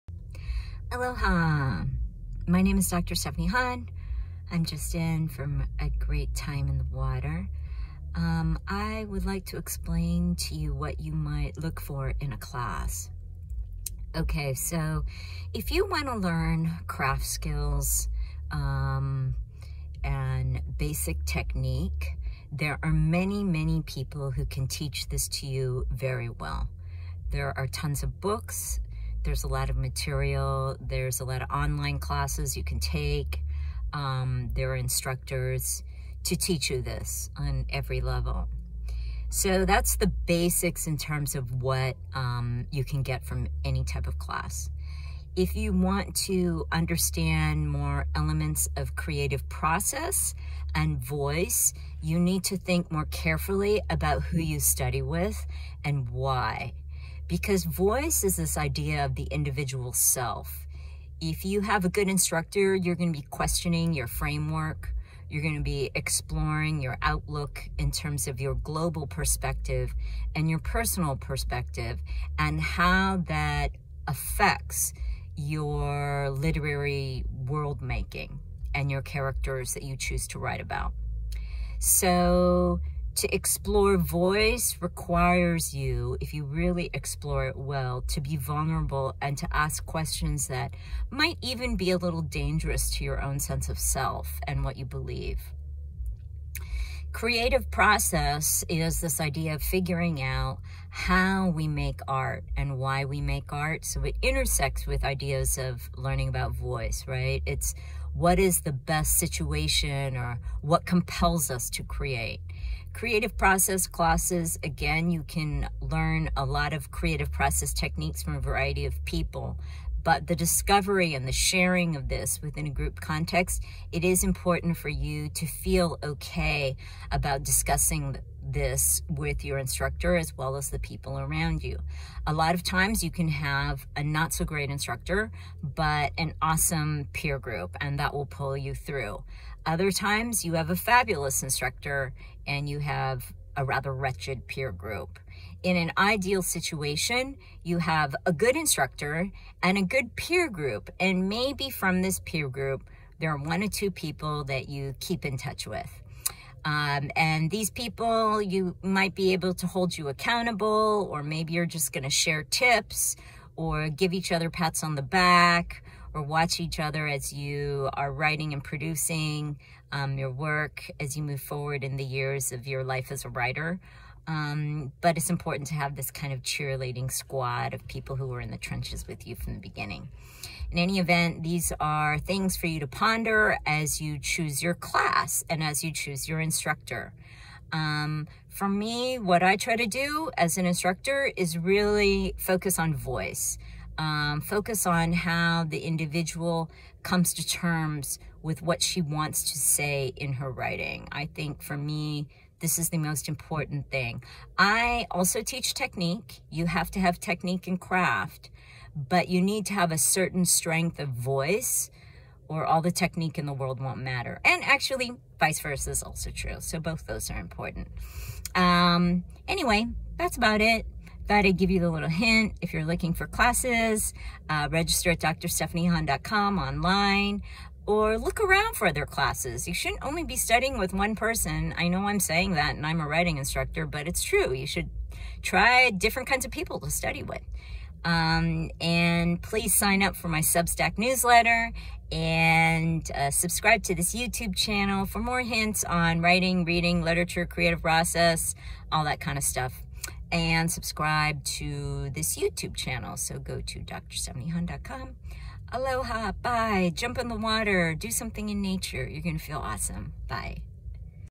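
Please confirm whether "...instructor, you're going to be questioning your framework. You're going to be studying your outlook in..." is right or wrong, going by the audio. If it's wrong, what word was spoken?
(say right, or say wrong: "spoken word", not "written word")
wrong: "exploring", not "studying".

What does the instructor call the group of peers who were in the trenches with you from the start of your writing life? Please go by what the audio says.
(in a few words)
Cheerleading squad.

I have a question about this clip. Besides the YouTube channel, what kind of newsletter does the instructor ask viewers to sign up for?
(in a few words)
Substack newsletter.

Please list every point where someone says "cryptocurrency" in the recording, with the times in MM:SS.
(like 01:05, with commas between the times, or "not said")
not said.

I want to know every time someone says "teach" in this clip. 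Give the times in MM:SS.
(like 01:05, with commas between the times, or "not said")
00:24, 00:36, 03:25.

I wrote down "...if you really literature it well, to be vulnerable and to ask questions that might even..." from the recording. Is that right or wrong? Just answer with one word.
wrong.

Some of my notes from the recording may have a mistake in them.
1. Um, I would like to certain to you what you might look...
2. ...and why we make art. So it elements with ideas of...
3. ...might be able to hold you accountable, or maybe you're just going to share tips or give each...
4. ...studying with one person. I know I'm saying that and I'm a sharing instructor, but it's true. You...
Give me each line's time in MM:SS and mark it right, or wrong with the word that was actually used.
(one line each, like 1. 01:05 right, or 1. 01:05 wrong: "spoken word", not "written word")
1. 00:08 wrong: "explain", not "certain"
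2. 01:42 wrong: "intersects", not "elements"
3. 02:38 right
4. 03:50 wrong: "writing", not "sharing".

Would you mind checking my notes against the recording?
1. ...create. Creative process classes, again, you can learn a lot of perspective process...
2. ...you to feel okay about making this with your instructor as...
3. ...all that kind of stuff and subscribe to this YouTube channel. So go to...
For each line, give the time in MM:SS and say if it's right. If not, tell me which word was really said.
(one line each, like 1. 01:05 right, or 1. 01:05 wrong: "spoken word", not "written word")
1. 01:51 wrong: "creative", not "perspective"
2. 02:04 wrong: "discussing", not "making"
3. 04:08 right.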